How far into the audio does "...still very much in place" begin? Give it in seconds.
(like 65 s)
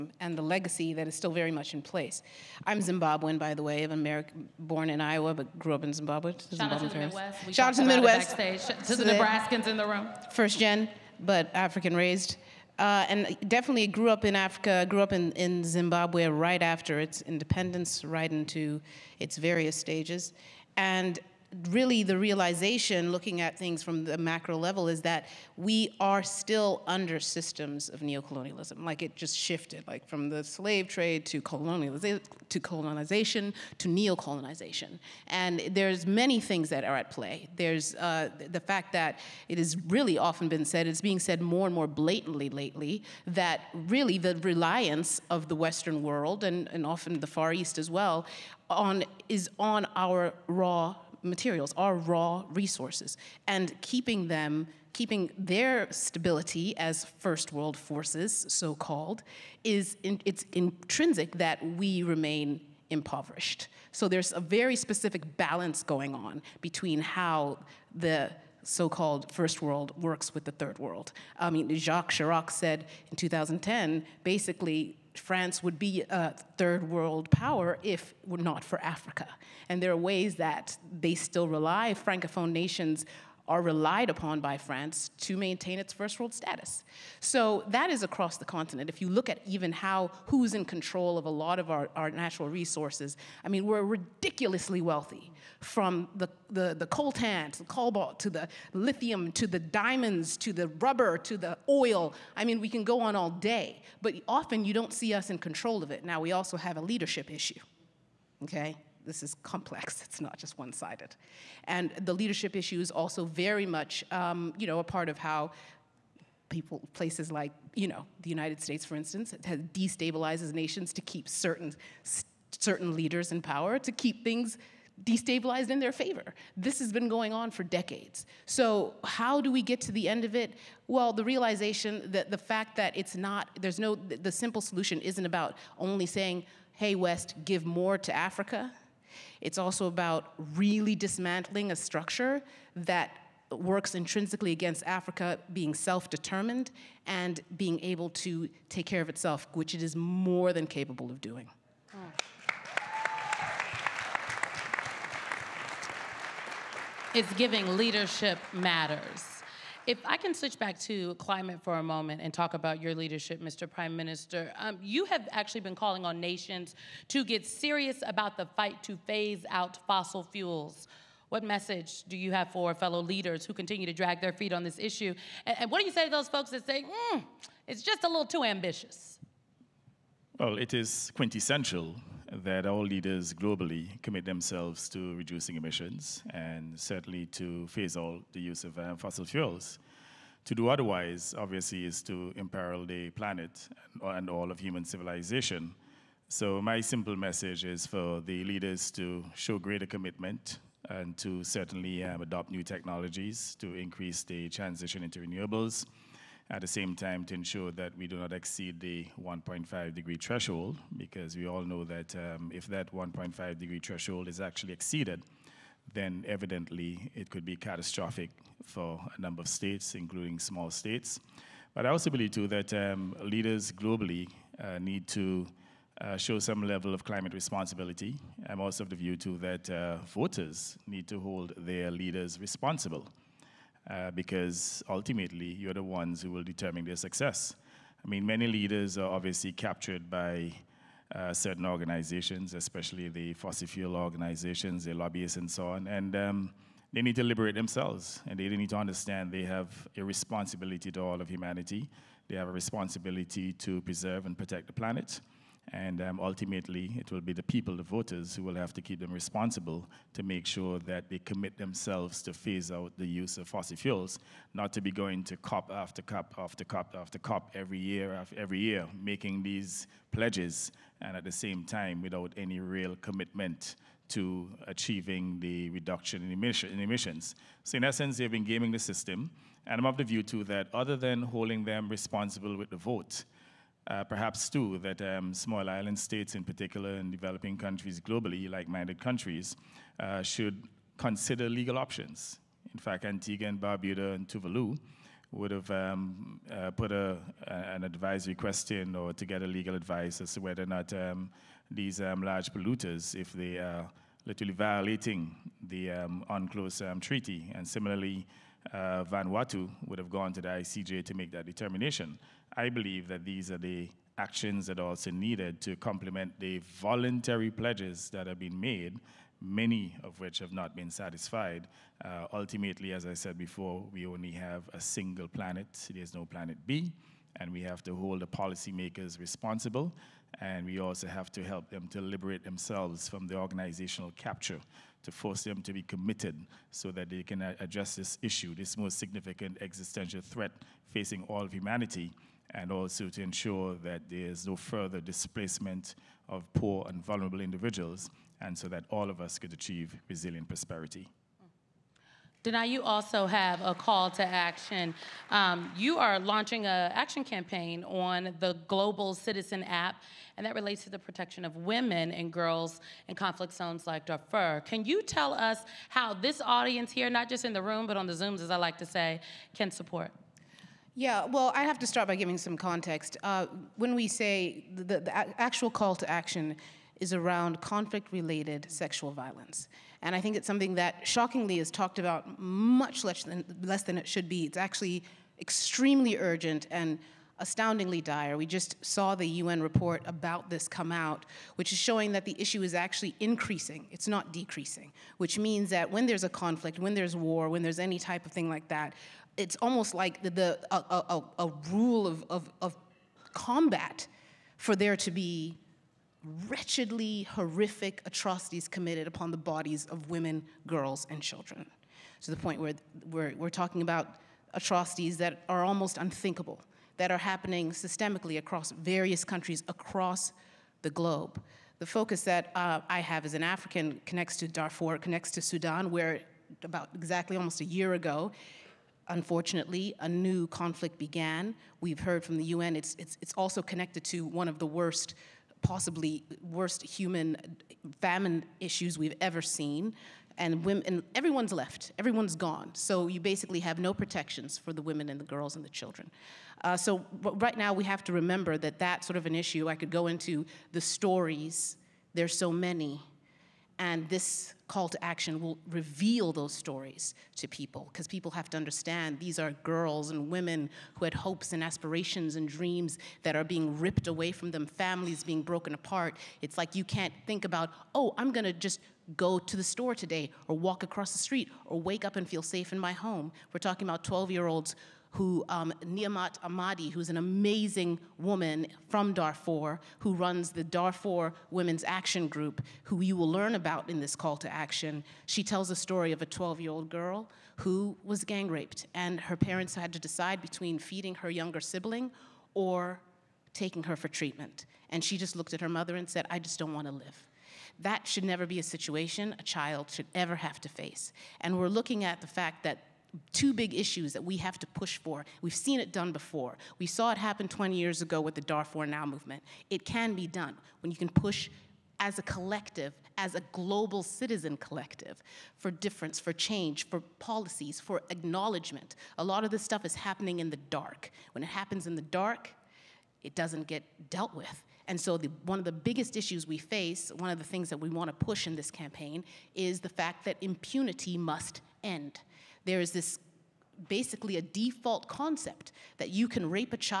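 1 s.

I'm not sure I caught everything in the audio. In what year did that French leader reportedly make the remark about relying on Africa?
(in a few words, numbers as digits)
2010.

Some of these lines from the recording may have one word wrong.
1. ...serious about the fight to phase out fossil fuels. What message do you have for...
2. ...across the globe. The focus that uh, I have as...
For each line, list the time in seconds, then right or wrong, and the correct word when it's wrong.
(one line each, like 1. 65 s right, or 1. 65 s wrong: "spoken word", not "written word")
1. 167 s right
2. 419 s right.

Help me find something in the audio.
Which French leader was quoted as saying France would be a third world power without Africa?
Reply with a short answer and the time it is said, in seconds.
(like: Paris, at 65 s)
Jacques Chirac, at 71 s.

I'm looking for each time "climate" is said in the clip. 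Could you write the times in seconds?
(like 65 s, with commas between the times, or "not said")
161 s, 227 s.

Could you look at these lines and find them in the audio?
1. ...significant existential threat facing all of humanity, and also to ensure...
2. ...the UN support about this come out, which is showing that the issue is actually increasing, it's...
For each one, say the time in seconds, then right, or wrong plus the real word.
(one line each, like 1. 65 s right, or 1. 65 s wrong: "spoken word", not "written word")
1. 338 s right
2. 389 s wrong: "report", not "support".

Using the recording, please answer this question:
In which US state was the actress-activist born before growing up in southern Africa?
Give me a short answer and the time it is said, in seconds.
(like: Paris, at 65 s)
Iowa, at 4 s.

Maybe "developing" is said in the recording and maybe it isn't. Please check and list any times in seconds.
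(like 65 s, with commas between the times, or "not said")
287 s.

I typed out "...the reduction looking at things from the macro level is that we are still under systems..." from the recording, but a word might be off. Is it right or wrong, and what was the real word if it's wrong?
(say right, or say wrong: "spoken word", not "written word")
wrong: "realization", not "reduction".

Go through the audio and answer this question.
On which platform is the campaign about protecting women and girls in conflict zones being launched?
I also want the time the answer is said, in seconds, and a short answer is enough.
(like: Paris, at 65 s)
Global Citizen app, at 358 s.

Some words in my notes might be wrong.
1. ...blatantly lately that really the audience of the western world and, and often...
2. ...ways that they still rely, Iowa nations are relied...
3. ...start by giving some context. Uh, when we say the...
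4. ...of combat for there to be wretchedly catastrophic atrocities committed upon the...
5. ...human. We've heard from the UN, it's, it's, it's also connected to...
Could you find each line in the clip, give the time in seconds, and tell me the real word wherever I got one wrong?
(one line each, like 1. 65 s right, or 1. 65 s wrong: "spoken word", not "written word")
1. 41 s wrong: "reliance", not "audience"
2. 79 s wrong: "Francophone", not "Iowa"
3. 371 s right
4. 402 s wrong: "horrific", not "catastrophic"
5. 430 s wrong: "began", not "human".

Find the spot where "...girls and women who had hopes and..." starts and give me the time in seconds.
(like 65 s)
459 s.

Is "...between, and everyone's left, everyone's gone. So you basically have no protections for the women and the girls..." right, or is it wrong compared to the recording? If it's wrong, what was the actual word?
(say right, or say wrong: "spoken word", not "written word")
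wrong: "women", not "between".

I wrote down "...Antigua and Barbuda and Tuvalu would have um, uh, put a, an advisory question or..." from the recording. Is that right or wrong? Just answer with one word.
right.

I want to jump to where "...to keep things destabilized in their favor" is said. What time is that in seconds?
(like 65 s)
123 s.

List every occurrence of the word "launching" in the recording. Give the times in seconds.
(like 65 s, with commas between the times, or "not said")
356 s.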